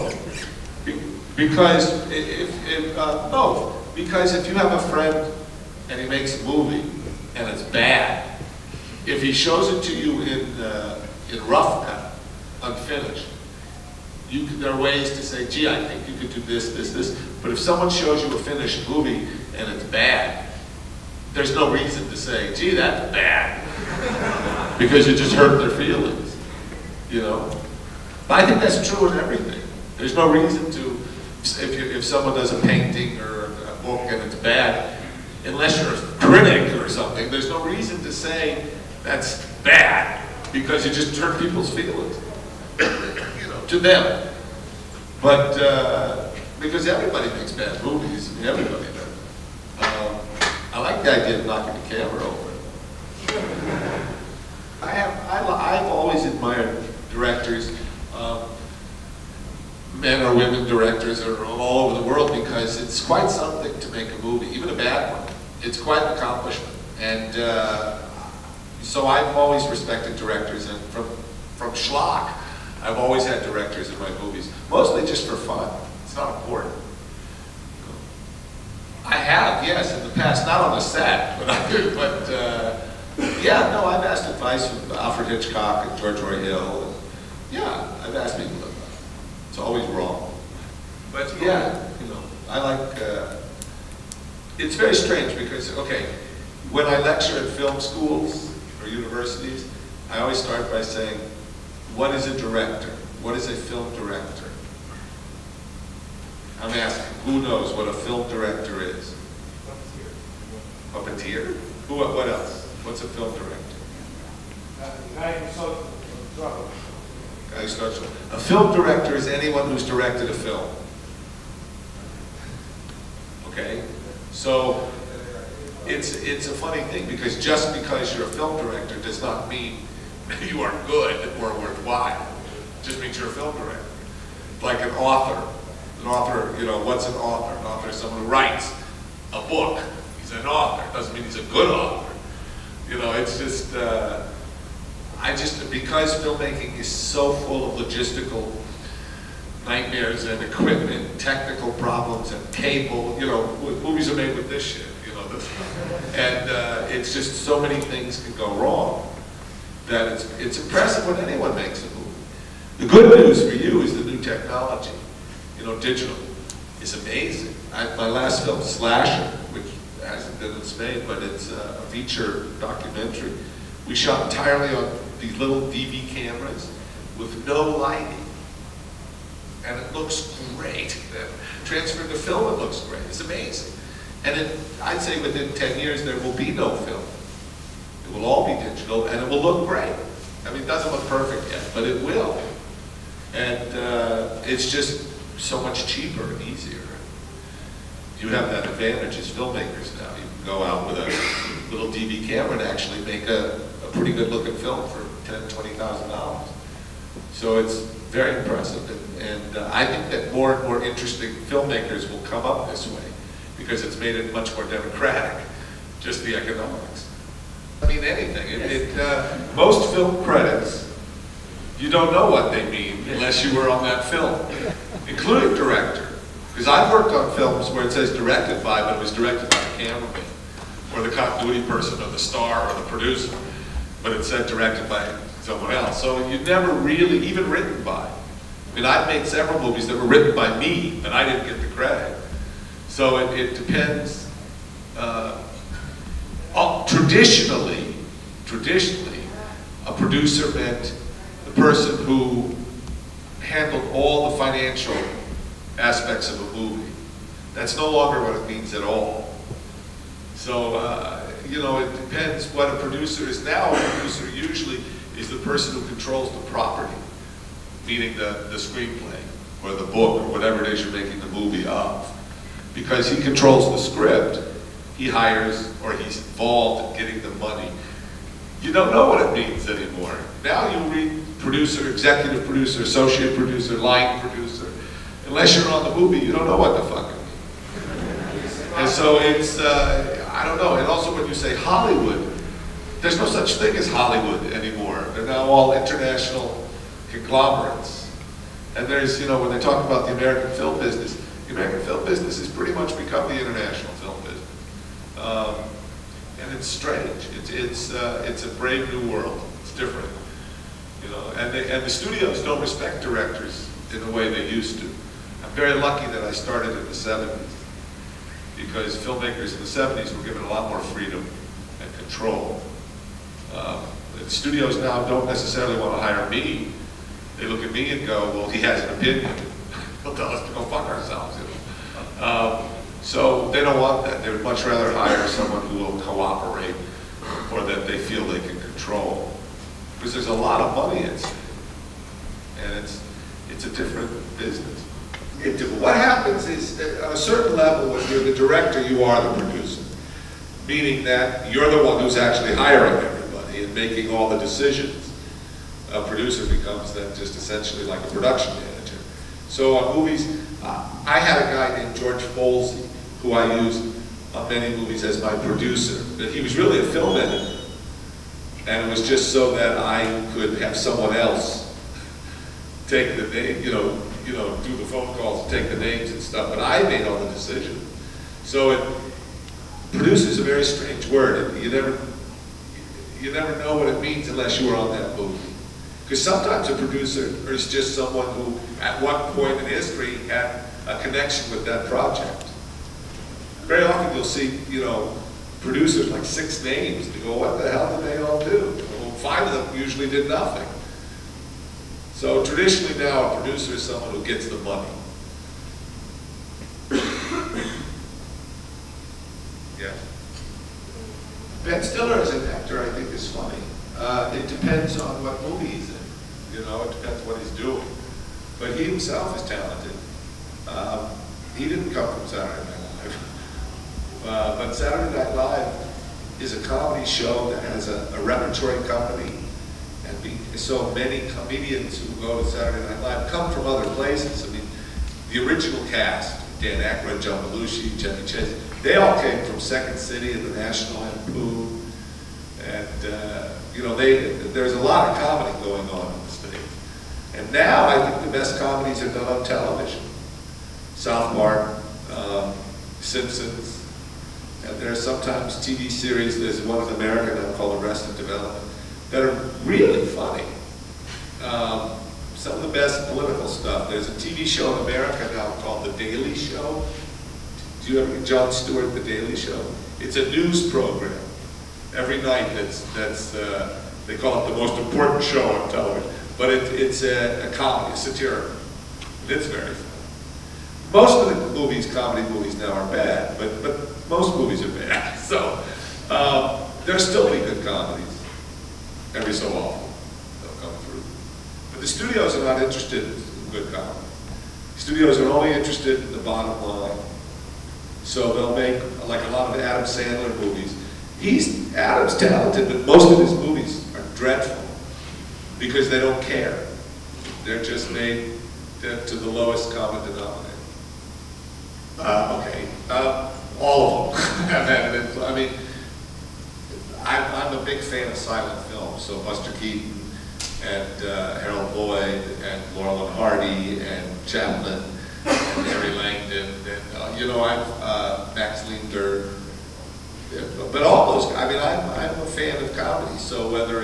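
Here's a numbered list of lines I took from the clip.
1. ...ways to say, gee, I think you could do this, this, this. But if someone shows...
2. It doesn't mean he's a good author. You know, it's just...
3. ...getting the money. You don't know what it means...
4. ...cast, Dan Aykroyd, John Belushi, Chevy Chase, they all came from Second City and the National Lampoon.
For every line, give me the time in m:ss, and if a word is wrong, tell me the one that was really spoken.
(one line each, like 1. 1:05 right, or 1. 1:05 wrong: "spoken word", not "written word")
1. 0:14 right
2. 2:20 right
3. 4:37 right
4. 7:15 right.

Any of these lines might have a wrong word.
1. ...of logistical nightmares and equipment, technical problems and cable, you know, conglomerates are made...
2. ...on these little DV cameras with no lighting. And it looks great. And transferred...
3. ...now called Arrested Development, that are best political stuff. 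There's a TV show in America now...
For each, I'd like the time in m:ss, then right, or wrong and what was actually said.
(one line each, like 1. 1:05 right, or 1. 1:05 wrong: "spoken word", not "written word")
1. 2:27 wrong: "movies", not "conglomerates"
2. 2:54 right
3. 7:37 right.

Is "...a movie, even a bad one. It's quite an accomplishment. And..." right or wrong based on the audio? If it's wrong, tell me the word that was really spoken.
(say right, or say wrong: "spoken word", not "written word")
right.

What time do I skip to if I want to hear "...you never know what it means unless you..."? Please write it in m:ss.
6:23.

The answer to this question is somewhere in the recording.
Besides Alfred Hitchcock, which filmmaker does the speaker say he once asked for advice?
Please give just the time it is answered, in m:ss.
1:25.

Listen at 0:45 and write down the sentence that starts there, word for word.
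But uh, because everybody makes bad movies, I mean, everybody does.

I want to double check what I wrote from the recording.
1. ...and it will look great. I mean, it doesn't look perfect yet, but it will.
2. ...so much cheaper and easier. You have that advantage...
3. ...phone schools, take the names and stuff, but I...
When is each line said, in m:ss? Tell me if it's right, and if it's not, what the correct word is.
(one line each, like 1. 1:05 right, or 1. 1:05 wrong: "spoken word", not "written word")
1. 3:09 right
2. 3:15 right
3. 6:14 wrong: "calls", not "schools".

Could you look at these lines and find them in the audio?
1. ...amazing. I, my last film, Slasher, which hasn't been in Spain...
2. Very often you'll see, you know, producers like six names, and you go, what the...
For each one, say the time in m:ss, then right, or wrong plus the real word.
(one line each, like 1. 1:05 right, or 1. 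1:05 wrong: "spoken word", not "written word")
1. 2:47 right
2. 6:33 right.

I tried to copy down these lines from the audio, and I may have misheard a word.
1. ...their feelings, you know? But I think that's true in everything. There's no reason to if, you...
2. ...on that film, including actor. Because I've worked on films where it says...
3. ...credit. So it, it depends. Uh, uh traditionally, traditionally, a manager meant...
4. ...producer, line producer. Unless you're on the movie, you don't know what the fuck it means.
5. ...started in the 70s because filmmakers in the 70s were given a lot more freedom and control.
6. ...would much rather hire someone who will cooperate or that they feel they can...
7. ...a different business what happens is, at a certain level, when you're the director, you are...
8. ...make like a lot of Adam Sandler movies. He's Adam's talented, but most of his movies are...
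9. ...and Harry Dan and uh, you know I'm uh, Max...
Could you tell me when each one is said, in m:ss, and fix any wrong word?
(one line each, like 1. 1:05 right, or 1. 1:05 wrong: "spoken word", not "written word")
1. 0:25 right
2. 3:43 wrong: "director", not "actor"
3. 4:01 wrong: "producer", not "manager"
4. 4:43 right
5. 5:16 right
6. 5:34 right
7. 5:43 right
8. 8:18 right
9. 8:45 wrong: "Langdon", not "Dan".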